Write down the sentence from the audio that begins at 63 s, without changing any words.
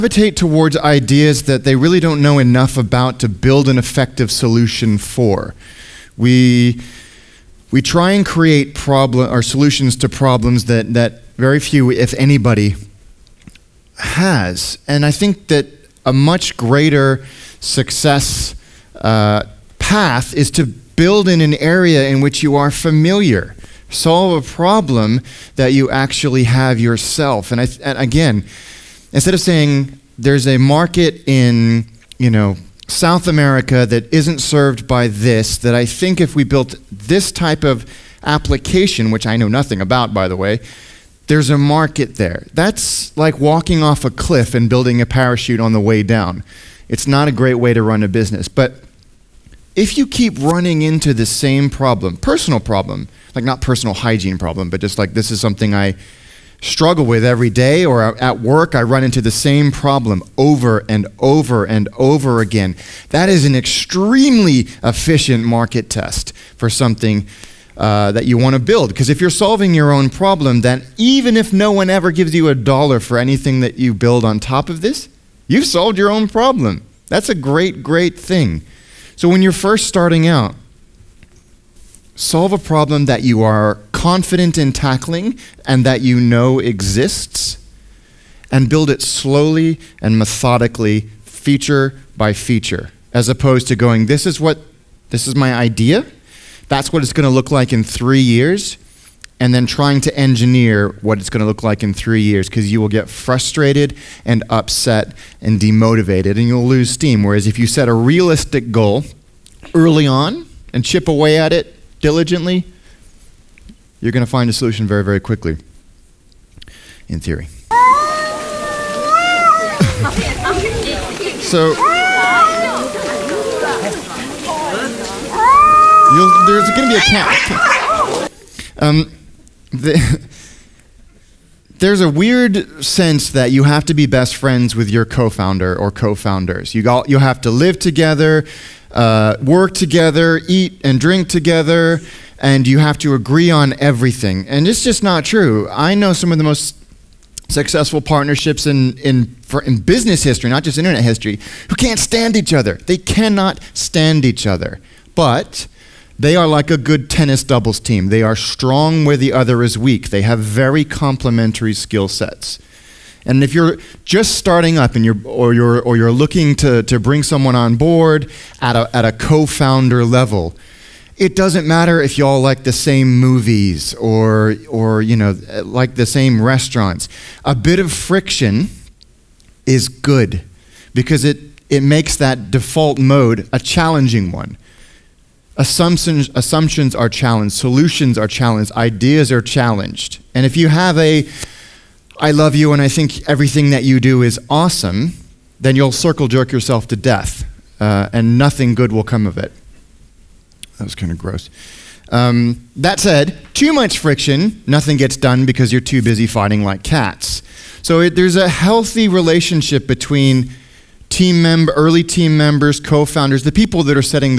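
That is an extremely efficient market test for something uh, that you want to build.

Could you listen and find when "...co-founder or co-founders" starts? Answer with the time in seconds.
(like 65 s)
135 s.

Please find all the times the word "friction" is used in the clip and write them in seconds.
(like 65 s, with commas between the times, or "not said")
177 s, 203 s.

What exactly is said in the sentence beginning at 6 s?
We, we try and create problem or solutions to problems that, that very few, if anybody, has.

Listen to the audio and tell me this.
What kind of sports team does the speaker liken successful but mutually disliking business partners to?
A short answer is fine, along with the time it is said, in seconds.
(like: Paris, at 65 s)
Tennis doubles team, at 157 s.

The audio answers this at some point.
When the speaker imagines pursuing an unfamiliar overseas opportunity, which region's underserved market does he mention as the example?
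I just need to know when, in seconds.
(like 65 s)
32 s.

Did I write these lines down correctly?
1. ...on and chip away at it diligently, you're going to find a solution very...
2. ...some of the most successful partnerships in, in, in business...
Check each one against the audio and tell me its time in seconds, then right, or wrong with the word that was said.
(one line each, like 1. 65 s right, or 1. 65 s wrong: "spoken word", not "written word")
1. 110 s right
2. 146 s right.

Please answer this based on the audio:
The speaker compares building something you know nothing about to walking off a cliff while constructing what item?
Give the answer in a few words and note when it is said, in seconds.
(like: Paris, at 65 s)
A parachute, at 45 s.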